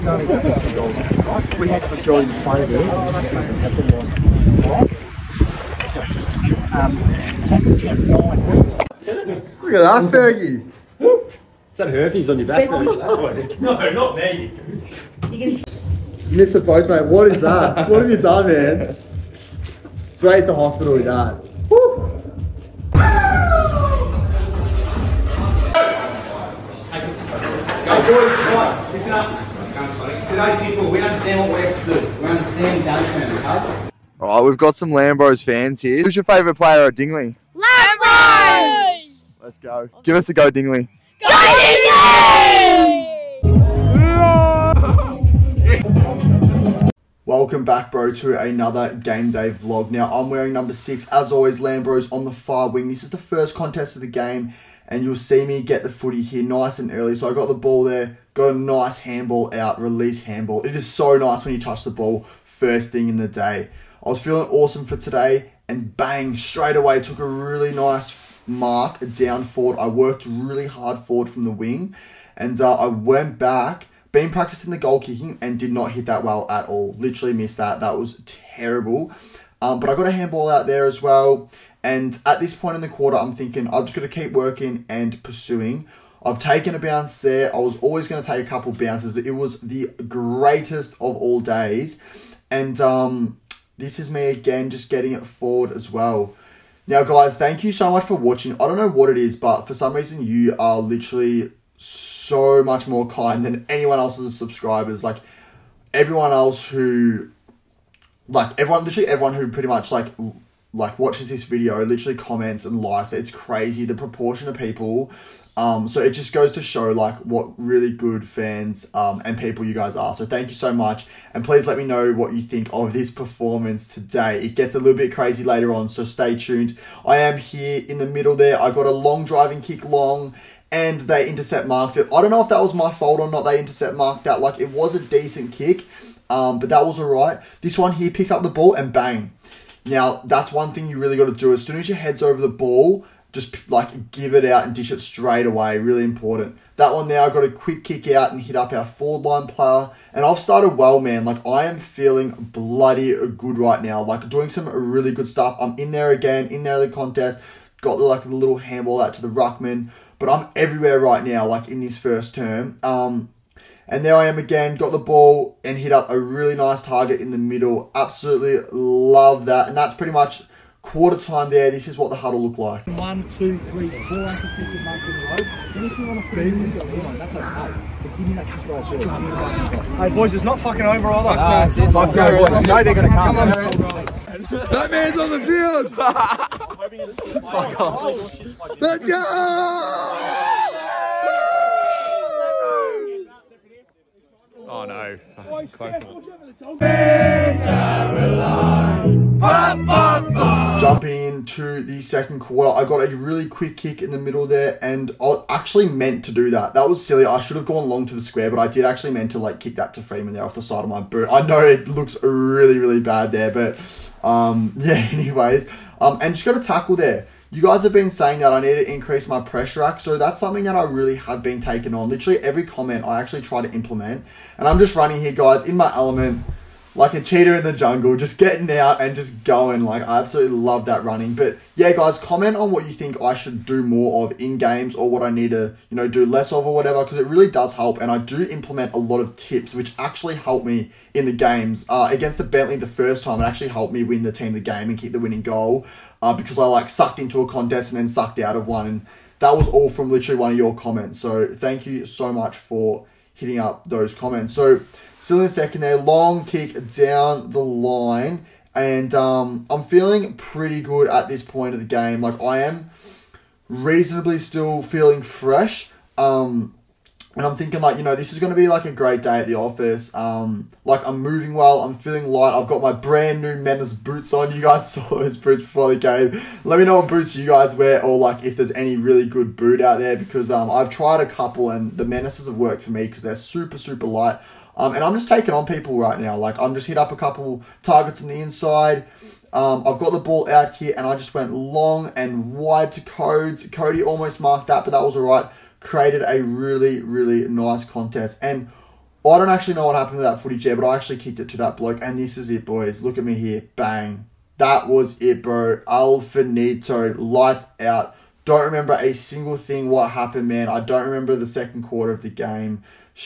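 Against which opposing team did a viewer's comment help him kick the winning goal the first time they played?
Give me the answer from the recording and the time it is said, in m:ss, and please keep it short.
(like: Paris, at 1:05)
Bentleigh, at 4:02.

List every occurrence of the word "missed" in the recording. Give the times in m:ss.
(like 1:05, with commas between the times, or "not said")
0:16, 1:17.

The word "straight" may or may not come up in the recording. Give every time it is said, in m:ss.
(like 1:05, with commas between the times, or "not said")
0:19, 1:06, 2:25.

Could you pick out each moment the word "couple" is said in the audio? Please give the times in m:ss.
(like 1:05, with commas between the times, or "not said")
1:28, 4:41, 4:47.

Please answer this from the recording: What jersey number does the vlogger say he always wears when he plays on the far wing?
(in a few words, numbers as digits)
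6.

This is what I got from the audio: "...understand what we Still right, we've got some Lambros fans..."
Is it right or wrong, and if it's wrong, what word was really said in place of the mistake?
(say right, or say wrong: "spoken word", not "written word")
wrong: "All", not "Still".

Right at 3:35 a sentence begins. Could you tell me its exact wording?
Anyways, um, and just got a tackle there.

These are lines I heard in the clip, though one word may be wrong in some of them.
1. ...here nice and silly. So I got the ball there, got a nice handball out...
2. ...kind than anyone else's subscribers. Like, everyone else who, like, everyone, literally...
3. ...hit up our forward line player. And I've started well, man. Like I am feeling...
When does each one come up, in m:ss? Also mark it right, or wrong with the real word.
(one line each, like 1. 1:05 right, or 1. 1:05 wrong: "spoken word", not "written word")
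1. 0:56 wrong: "early", not "silly"
2. 1:43 right
3. 2:28 right.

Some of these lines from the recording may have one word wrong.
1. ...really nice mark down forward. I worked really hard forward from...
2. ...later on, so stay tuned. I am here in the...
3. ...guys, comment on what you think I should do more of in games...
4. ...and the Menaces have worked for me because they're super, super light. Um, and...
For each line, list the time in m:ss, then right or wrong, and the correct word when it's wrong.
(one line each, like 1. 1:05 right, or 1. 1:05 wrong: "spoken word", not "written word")
1. 1:07 right
2. 2:05 right
3. 3:51 right
4. 4:41 right.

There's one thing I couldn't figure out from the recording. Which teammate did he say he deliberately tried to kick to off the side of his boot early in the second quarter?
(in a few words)
Freeman.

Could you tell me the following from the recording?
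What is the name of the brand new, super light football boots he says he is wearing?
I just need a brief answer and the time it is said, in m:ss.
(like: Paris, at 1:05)
Menace, at 4:33.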